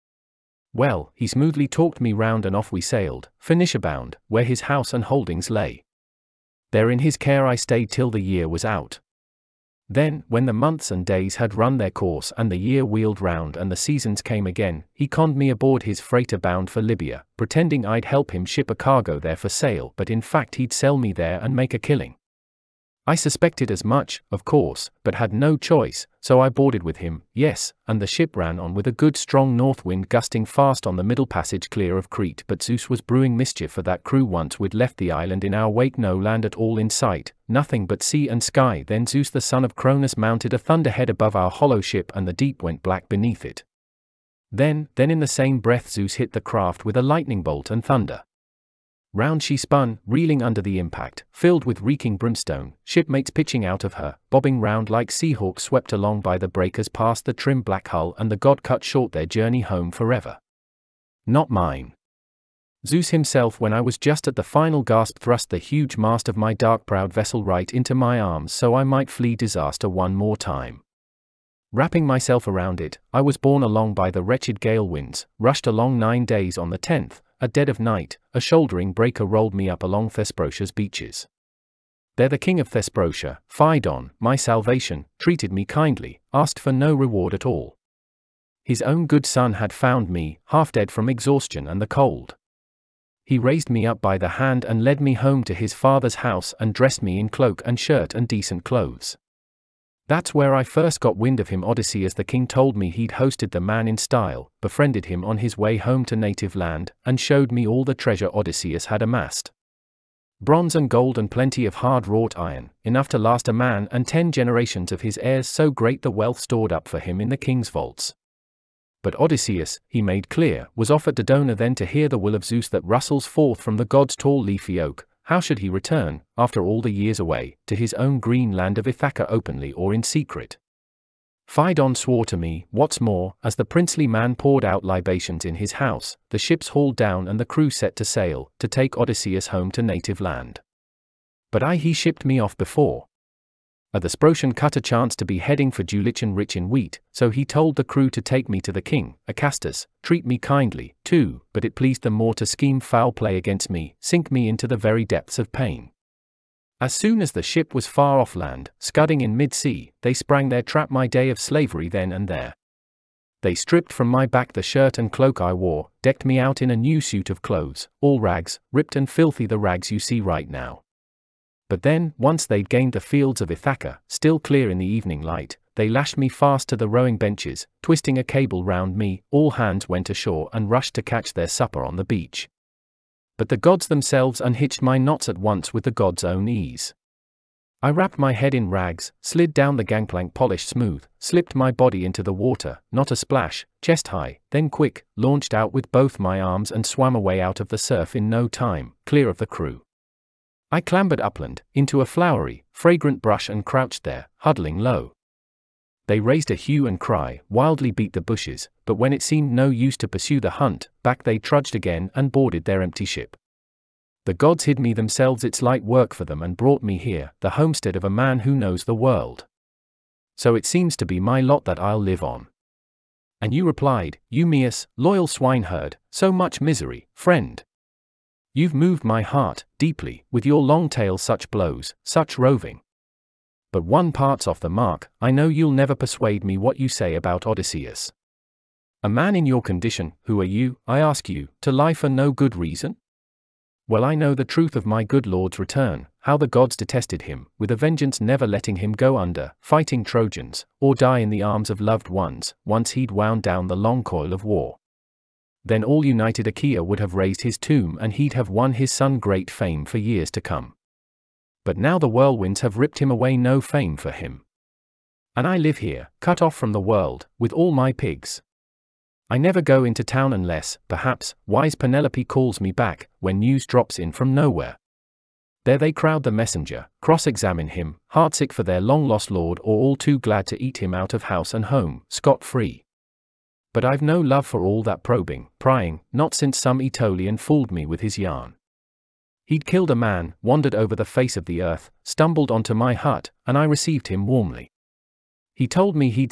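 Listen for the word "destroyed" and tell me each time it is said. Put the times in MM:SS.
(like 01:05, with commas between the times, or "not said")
not said.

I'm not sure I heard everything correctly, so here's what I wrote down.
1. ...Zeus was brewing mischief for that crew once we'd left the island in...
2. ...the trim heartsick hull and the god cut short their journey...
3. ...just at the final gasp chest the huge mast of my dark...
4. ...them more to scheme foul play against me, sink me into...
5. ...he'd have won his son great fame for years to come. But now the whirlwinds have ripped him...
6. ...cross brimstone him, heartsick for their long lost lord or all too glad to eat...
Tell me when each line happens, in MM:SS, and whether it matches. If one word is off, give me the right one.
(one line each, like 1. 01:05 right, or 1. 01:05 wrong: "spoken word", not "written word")
1. 00:32 right
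2. 00:57 wrong: "black", not "heartsick"
3. 01:03 wrong: "thrust", not "chest"
4. 02:32 right
5. 04:18 right
6. 04:37 wrong: "examine", not "brimstone".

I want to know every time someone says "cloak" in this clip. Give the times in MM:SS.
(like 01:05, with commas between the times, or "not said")
01:37, 02:45.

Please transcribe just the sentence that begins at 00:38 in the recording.
Then Zeus the son of Cronus mounted a thunderhead above our hollow ship, and the deep went black beneath it.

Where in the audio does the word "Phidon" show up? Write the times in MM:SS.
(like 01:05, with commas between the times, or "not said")
01:23, 02:11.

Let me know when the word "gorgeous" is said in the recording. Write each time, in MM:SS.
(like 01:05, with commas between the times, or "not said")
not said.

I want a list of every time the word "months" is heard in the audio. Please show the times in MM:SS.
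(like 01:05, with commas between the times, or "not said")
00:10.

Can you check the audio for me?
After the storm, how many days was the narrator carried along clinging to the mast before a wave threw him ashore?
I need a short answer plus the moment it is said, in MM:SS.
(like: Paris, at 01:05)
9, at 01:15.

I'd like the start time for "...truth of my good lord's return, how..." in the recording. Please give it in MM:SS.
04:04.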